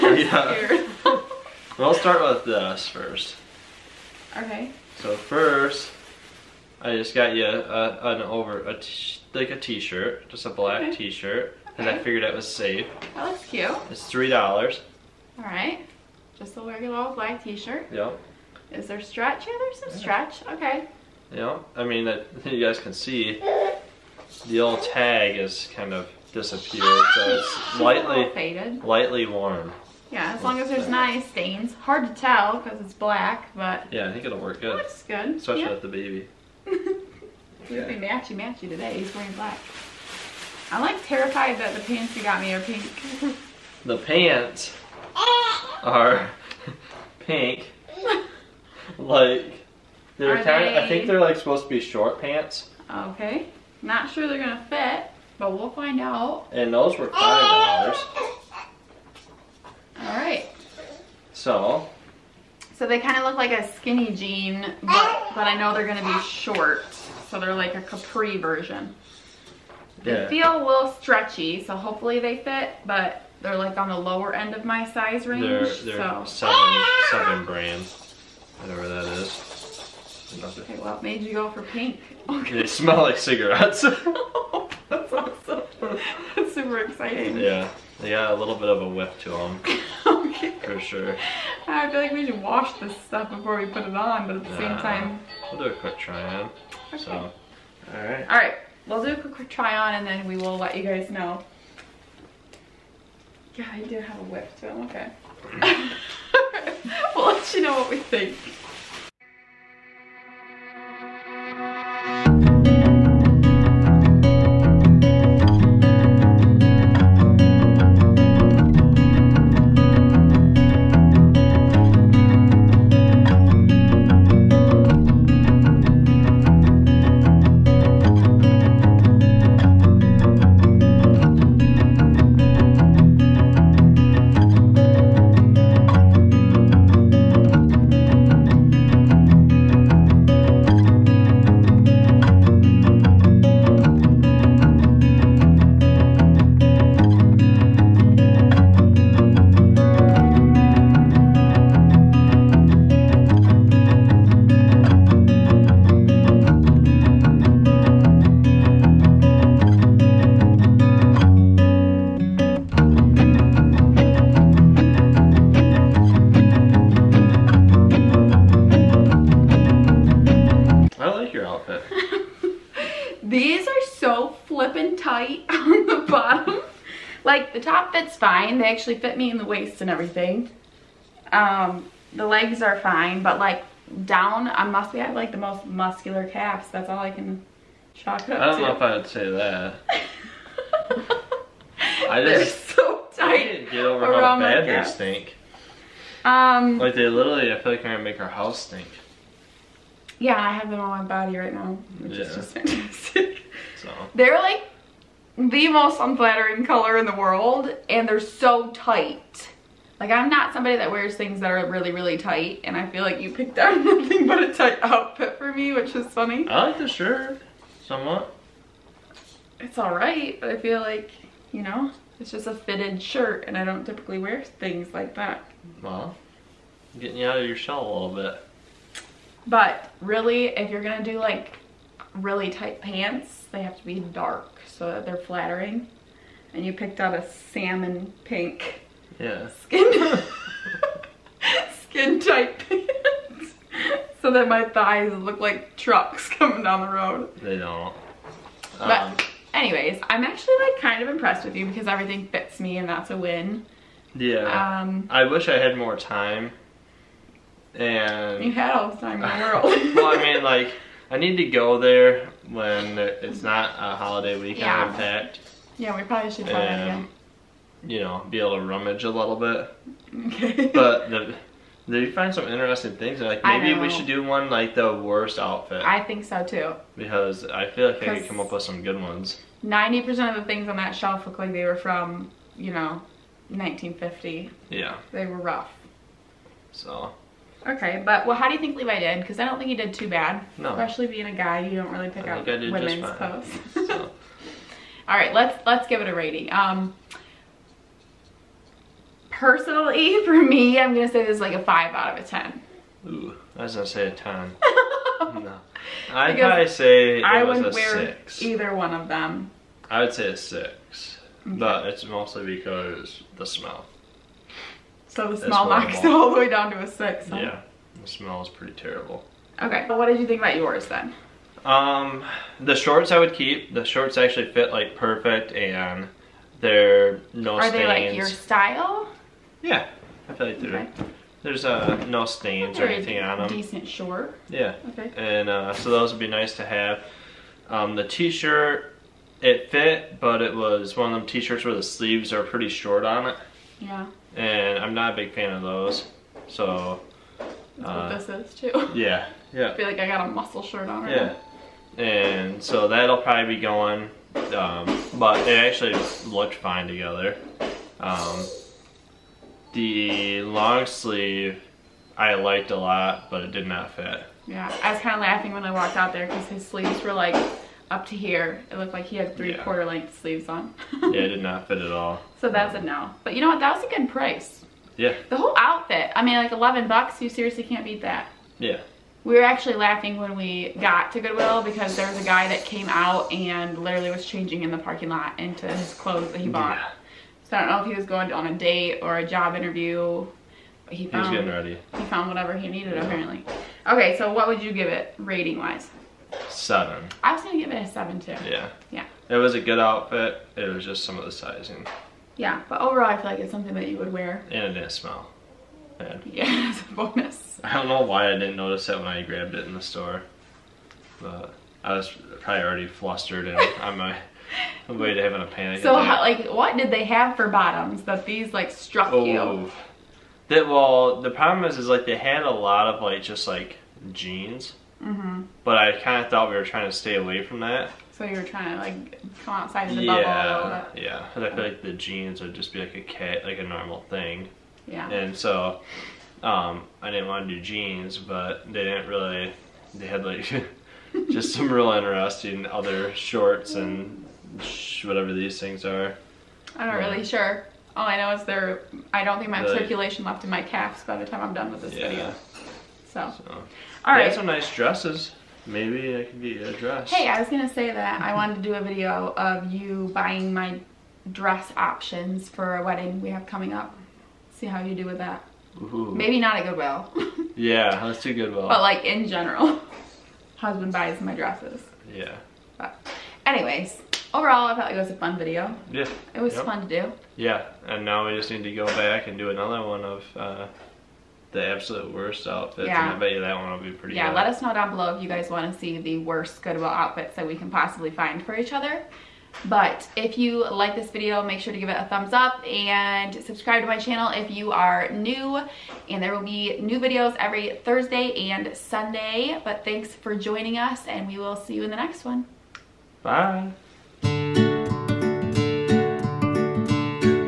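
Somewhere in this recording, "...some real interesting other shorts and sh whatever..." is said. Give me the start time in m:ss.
7:21.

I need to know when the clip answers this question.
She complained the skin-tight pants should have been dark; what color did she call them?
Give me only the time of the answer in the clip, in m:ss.
3:57.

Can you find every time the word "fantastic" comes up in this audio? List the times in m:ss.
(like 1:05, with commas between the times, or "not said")
3:22.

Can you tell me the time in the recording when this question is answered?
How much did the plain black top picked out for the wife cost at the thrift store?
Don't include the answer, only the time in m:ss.
0:14.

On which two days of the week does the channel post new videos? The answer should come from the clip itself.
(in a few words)
Thursday and Sunday.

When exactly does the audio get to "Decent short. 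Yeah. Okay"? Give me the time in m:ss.
5:33.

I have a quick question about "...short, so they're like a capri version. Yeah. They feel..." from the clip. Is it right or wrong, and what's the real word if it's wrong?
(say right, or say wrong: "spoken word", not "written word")
right.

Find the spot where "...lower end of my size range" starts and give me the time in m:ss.
1:13.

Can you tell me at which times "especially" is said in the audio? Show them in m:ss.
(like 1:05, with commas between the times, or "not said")
0:35, 4:50.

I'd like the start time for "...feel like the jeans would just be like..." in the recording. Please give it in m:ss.
7:11.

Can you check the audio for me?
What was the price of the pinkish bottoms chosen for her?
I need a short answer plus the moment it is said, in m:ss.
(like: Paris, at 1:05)
$5, at 0:57.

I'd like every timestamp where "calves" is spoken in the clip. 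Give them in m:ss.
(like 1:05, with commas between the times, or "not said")
3:06, 7:30.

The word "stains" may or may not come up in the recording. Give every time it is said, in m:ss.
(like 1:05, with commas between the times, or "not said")
0:31, 5:27, 5:32.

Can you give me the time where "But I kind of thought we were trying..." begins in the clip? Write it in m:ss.
7:05.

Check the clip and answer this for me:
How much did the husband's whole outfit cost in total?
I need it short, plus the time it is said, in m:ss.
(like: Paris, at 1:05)
$11, at 6:16.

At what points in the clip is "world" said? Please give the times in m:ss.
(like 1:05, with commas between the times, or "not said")
3:27, 4:19.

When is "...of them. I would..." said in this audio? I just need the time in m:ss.
5:08.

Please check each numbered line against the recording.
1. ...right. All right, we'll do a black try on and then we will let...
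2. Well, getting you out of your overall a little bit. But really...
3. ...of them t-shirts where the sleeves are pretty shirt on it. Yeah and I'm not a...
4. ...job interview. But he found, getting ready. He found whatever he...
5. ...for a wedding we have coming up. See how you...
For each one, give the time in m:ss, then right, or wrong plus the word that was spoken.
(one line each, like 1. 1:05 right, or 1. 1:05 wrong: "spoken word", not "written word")
1. 1:38 wrong: "quick", not "black"
2. 3:45 wrong: "shell", not "overall"
3. 5:41 wrong: "short", not "shirt"
4. 6:29 right
5. 7:42 right.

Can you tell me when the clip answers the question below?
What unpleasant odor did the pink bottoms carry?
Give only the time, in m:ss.
1:23.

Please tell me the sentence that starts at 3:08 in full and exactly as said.
know if I would say that.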